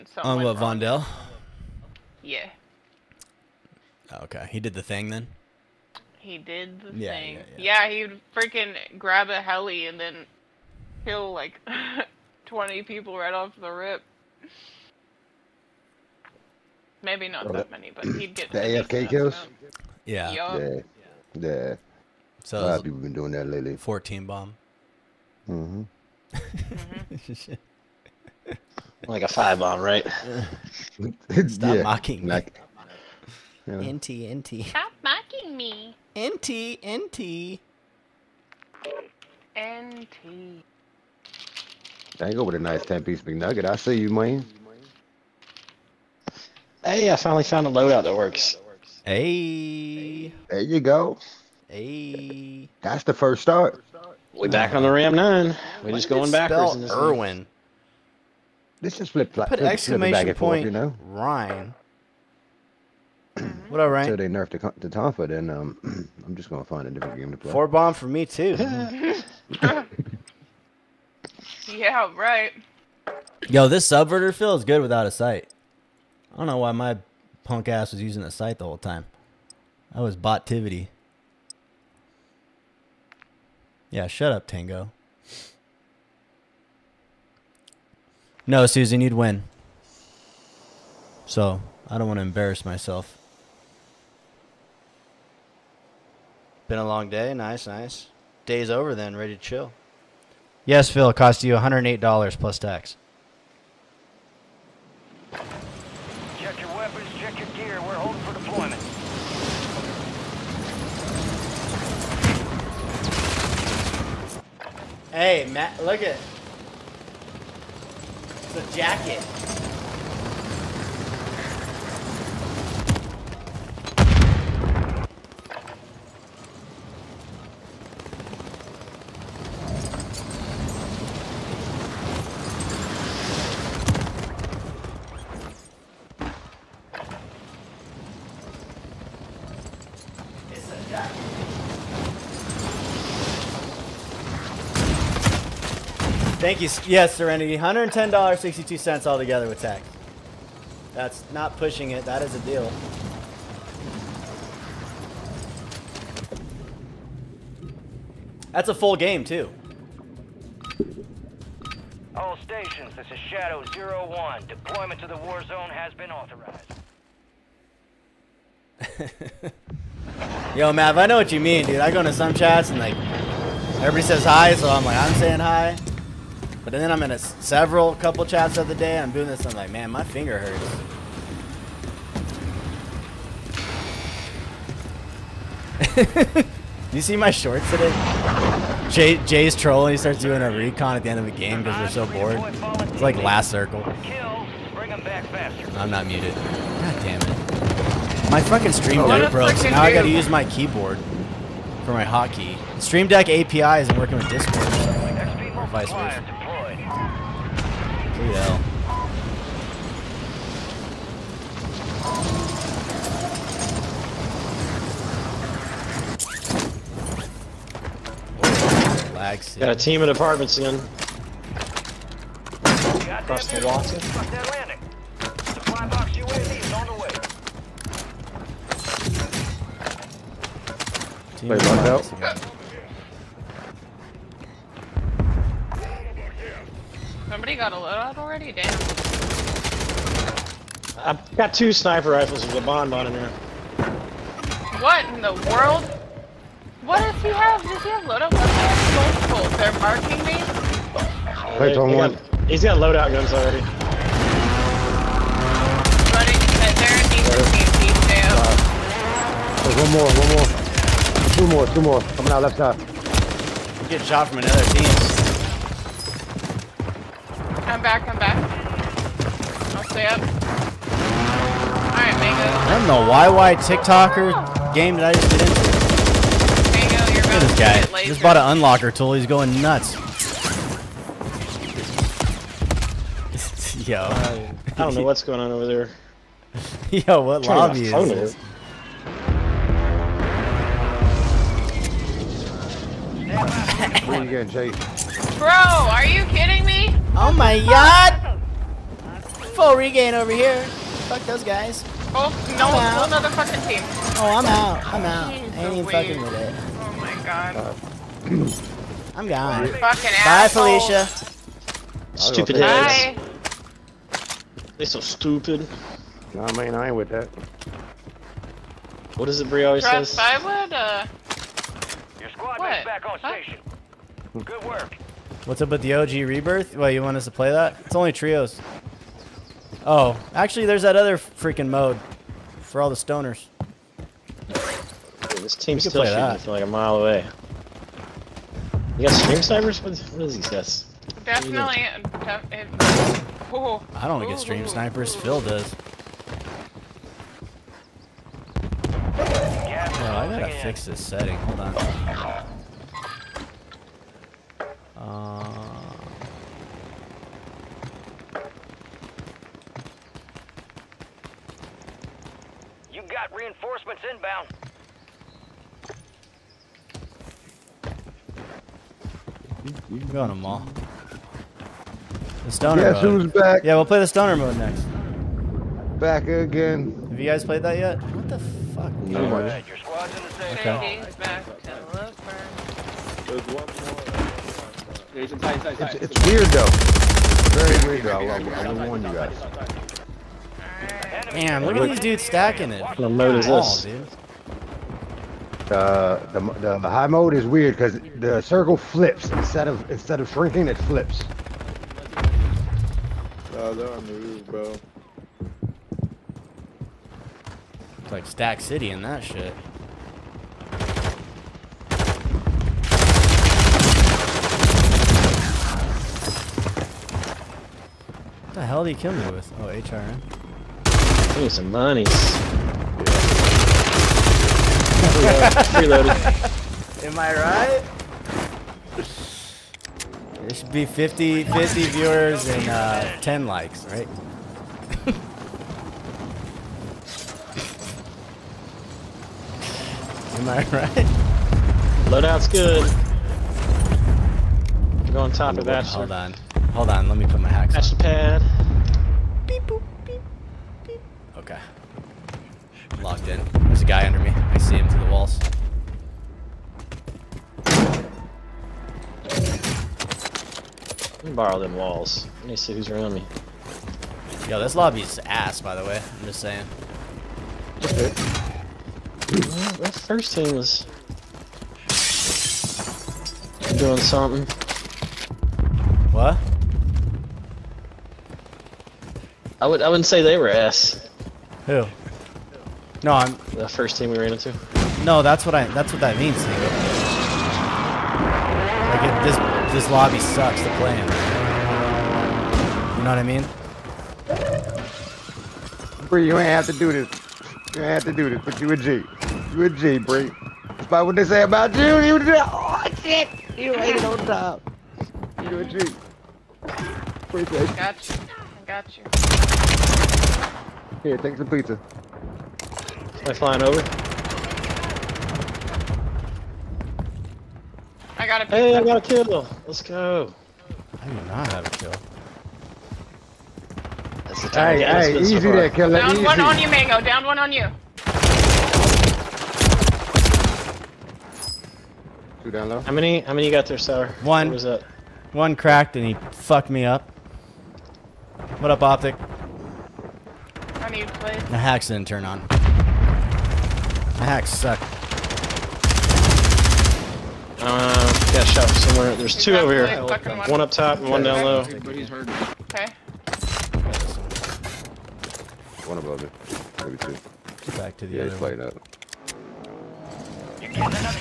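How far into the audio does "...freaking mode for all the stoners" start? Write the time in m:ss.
5:31.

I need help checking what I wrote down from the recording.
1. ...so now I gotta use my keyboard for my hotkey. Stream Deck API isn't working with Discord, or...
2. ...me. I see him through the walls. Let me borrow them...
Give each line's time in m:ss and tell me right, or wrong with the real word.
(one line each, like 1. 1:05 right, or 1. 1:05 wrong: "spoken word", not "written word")
1. 3:19 right
2. 7:34 right.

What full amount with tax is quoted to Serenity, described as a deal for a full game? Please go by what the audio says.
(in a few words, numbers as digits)
$110.62.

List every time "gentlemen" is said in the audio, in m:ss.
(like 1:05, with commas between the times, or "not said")
not said.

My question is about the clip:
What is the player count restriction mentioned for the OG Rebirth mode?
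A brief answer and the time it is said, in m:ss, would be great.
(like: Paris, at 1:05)
trios, at 5:28.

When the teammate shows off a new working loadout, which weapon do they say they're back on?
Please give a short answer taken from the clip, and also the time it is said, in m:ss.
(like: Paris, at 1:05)
Ram 9, at 0:54.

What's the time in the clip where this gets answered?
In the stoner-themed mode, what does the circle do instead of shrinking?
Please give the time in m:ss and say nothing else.
6:40.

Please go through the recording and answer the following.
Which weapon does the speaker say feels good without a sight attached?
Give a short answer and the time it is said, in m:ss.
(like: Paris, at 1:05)
subverter, at 1:13.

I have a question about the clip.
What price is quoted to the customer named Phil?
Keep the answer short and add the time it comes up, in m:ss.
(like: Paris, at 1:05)
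$108 plus tax, at 1:41.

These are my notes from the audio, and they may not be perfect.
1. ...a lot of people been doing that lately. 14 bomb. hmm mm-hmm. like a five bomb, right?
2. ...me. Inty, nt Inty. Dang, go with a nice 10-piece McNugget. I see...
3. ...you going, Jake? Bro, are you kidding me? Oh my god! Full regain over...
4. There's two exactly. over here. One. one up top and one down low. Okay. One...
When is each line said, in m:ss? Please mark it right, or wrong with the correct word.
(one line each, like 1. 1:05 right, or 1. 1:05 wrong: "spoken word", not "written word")
1. 0:22 right
2. 0:35 right
3. 4:54 right
4. 9:09 right.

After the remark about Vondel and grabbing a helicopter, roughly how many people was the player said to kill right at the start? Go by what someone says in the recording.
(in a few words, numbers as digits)
20.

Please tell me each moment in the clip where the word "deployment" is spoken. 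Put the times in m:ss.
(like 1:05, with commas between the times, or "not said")
1:48, 2:44.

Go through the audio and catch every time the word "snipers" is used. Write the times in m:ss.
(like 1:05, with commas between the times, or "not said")
4:01, 5:39, 5:44.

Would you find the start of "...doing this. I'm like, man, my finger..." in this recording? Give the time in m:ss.
2:59.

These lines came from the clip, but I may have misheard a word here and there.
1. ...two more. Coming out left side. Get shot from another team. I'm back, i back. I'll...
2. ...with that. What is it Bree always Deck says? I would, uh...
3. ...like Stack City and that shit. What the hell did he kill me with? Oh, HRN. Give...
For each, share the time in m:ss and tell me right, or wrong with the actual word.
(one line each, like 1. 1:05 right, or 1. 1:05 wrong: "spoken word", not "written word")
1. 4:21 right
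2. 5:16 wrong: "Trust", not "Deck"
3. 6:48 right.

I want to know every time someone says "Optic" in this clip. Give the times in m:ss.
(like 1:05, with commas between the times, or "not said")
8:58.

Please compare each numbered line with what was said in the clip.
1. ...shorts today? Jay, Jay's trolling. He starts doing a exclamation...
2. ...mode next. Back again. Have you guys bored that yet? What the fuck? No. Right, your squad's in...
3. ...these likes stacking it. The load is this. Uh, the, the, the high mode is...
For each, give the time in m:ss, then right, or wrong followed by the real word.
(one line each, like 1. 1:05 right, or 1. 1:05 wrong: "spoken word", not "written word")
1. 3:07 wrong: "recon", not "exclamation"
2. 6:14 wrong: "played", not "bored"
3. 6:31 wrong: "dudes", not "likes".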